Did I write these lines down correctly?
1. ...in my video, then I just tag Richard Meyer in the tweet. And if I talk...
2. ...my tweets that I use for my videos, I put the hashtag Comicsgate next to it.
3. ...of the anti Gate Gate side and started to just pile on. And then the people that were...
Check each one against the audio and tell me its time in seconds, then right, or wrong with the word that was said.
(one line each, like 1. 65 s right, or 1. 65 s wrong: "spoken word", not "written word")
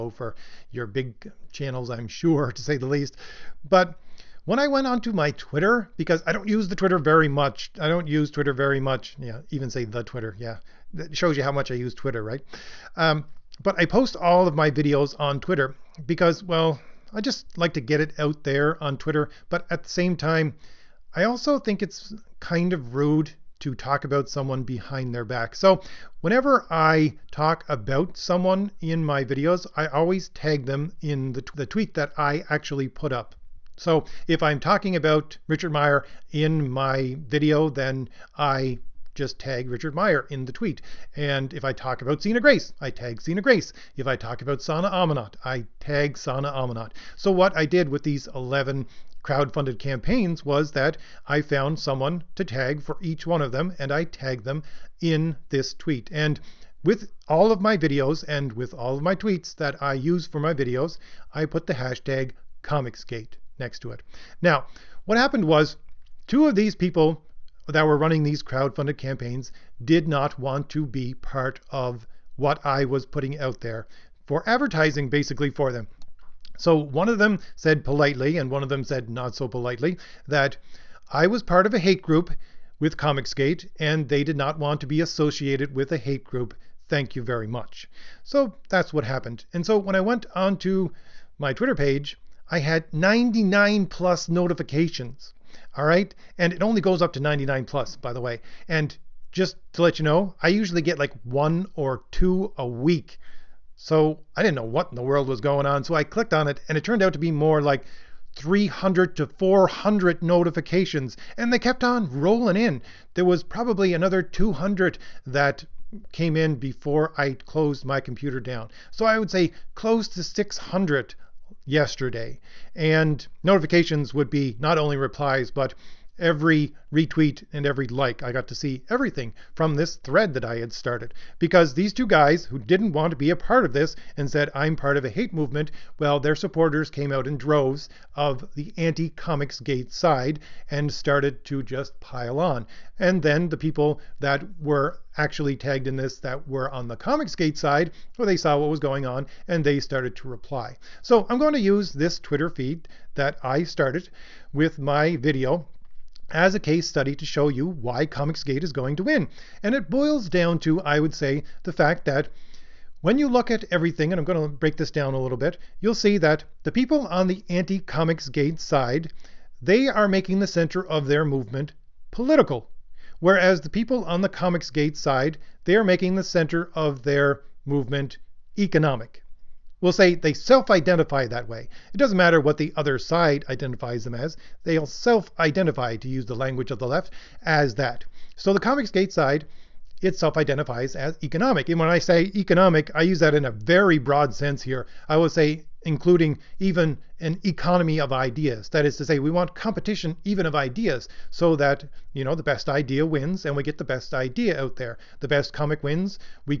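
1. 36 s right
2. 59 s right
3. 138 s wrong: "Comics", not "Gate".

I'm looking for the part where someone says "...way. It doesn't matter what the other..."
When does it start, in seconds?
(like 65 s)
181 s.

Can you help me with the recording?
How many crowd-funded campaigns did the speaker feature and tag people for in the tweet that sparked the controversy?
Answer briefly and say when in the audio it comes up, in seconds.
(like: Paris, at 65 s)
11, at 48 s.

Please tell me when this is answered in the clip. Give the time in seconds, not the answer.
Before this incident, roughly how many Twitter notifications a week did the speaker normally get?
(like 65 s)
101 s.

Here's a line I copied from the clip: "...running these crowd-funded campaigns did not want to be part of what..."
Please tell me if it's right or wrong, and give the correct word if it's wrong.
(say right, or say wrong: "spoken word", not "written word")
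right.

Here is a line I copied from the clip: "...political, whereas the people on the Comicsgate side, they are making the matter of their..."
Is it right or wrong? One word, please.
wrong.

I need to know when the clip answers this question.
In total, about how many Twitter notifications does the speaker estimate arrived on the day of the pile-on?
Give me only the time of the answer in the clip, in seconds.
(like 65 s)
120 s.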